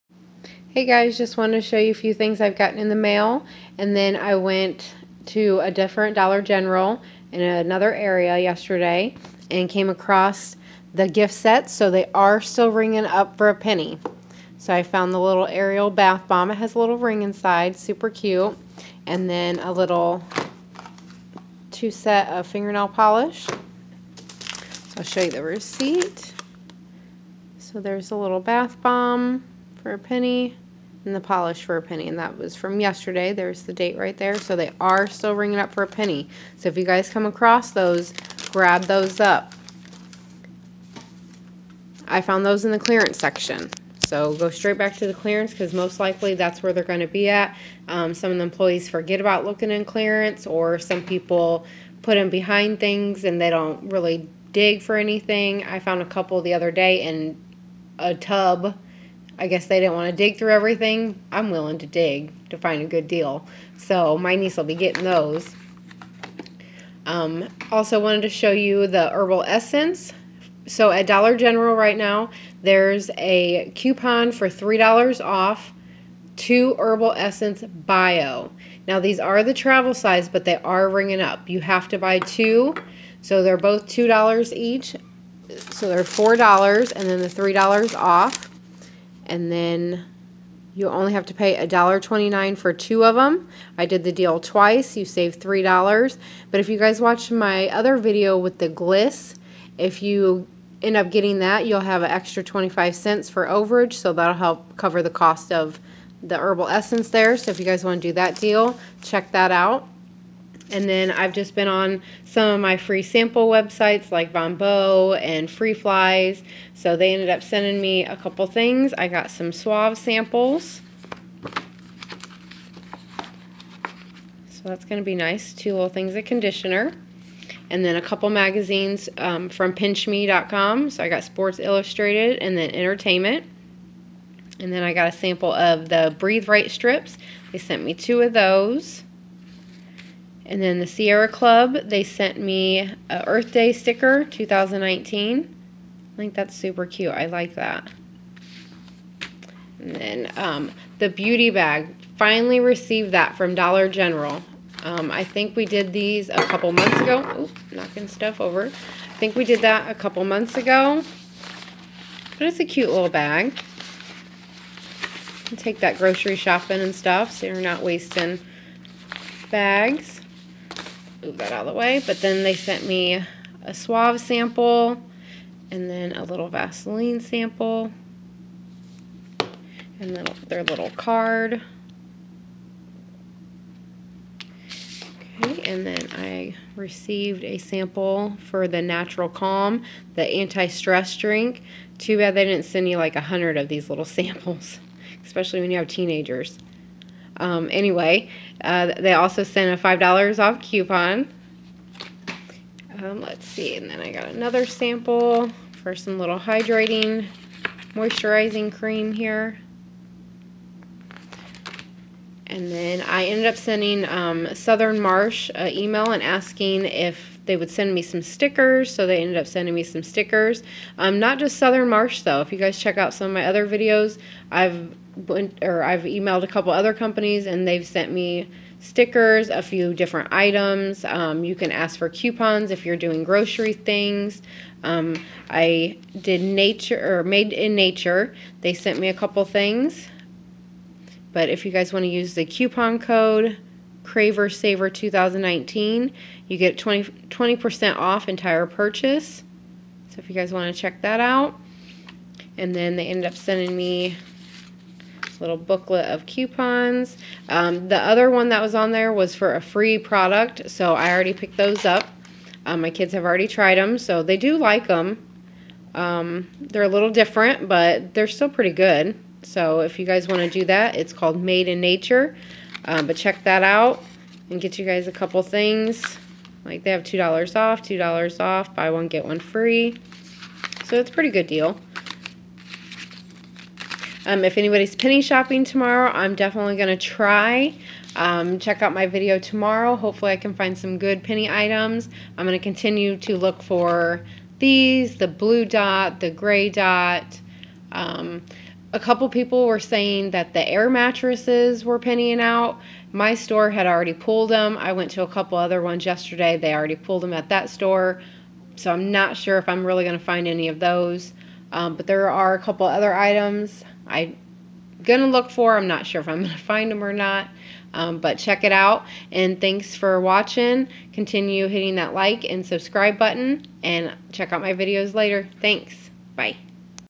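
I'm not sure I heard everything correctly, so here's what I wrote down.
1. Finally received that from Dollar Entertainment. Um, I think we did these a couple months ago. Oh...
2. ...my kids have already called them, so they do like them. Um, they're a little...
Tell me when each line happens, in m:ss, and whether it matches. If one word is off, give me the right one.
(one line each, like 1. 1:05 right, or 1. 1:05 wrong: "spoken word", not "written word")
1. 2:32 wrong: "General", not "Entertainment"
2. 4:22 wrong: "tried", not "called".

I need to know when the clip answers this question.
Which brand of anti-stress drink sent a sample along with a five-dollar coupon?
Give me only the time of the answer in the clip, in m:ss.
3:08.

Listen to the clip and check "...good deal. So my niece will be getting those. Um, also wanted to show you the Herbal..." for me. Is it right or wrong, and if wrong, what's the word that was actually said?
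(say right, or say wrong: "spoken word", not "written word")
right.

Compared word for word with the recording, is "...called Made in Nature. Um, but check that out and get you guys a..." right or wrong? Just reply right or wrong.
right.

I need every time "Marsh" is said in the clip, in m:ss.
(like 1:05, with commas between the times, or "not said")
3:34, 3:41.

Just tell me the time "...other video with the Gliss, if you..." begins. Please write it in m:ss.
1:37.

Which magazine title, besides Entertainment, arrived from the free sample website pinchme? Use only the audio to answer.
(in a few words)
Sports Illustrated.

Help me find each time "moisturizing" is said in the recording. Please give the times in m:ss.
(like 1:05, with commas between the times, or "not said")
3:27.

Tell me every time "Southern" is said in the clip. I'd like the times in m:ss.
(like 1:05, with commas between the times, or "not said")
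3:34, 3:41.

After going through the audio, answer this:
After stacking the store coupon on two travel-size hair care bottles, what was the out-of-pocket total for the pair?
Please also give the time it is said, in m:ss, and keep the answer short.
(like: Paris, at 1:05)
$1.29, at 1:31.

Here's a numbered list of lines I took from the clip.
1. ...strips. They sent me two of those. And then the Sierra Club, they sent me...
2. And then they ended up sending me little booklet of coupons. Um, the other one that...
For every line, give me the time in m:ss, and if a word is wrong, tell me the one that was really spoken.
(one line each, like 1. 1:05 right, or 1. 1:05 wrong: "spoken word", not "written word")
1. 2:16 right
2. 4:12 right.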